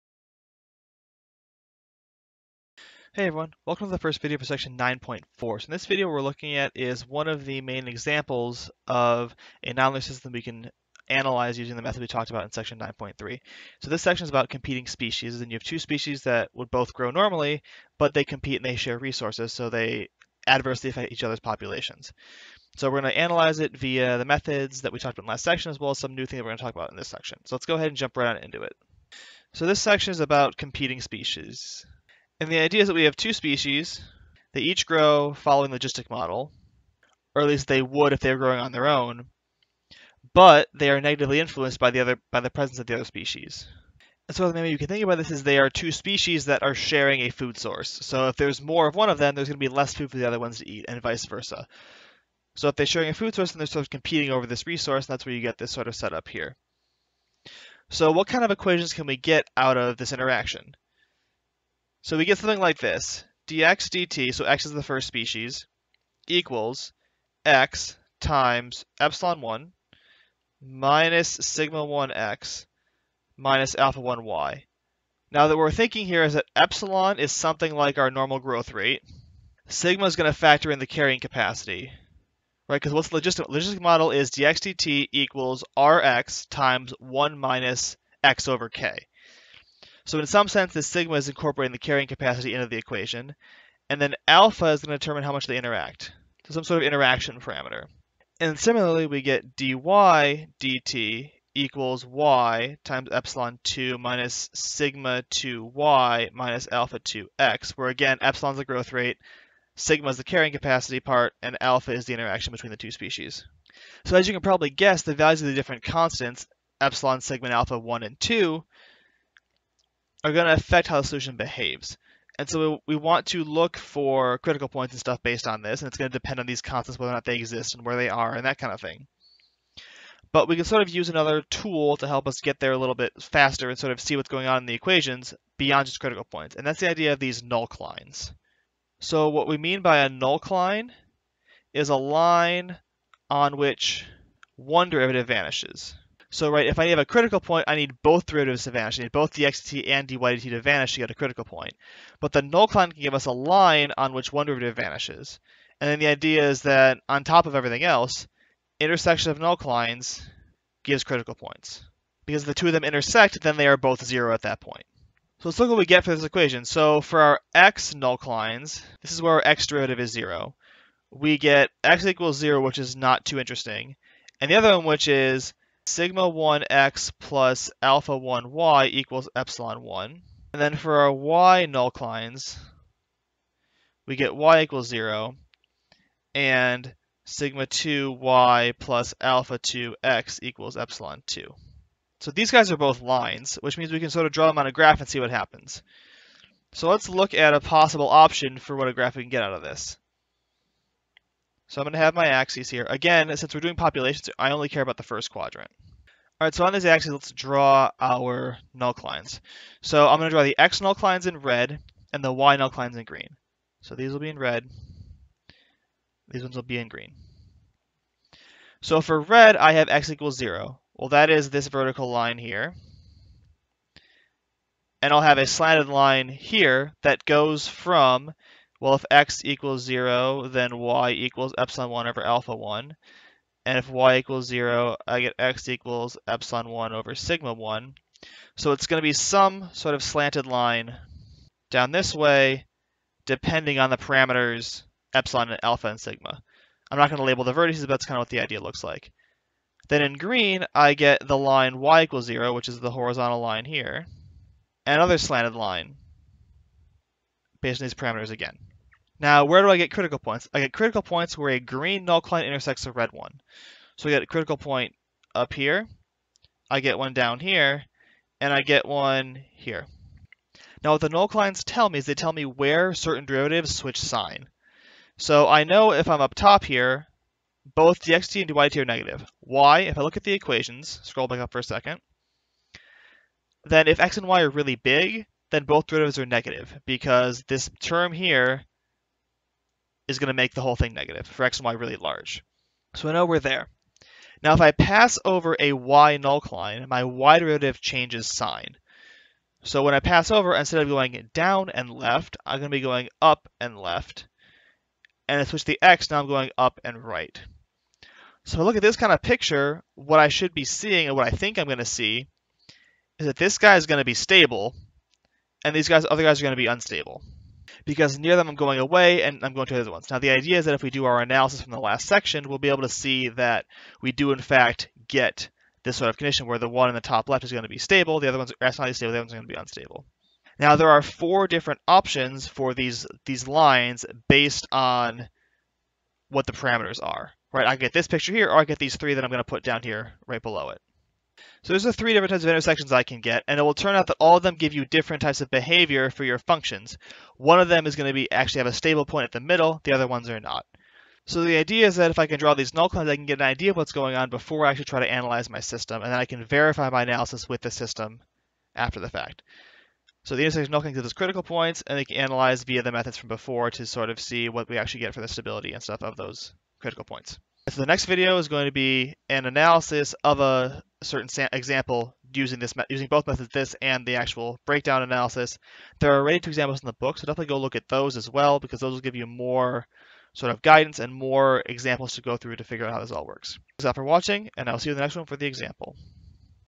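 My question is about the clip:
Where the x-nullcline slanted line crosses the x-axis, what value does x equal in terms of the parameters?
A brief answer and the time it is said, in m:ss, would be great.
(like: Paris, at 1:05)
Epsilon 1 over sigma 1, at 3:56.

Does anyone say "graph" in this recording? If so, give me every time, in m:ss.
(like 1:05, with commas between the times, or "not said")
3:14, 3:18.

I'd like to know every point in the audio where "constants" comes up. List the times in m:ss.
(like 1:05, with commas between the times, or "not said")
1:55, 2:06.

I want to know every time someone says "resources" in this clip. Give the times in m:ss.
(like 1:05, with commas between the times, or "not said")
0:18, 0:54.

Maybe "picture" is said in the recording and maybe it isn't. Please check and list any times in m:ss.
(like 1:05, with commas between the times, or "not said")
5:09, 5:38.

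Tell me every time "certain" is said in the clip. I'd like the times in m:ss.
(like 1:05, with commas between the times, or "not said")
4:32, 6:11.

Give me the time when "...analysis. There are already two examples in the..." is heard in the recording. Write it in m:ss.
6:15.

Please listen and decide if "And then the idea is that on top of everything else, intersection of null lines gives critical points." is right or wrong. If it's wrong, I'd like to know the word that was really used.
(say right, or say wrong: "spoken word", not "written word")
right.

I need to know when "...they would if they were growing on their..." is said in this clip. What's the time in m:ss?
0:37.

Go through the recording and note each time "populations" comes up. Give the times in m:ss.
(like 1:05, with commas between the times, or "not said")
0:21, 3:23.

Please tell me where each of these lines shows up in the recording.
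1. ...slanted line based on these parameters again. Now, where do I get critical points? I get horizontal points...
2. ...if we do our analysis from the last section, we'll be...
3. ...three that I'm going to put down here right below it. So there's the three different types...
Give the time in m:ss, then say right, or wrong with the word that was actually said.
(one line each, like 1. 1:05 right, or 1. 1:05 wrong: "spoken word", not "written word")
1. 4:15 wrong: "critical", not "horizontal"
2. 5:20 right
3. 5:38 right.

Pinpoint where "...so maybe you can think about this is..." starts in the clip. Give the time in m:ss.
0:44.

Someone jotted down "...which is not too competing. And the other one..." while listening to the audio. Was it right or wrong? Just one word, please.
wrong.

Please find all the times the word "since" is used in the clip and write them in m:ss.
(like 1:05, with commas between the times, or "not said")
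3:23.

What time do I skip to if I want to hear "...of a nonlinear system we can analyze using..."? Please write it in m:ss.
0:08.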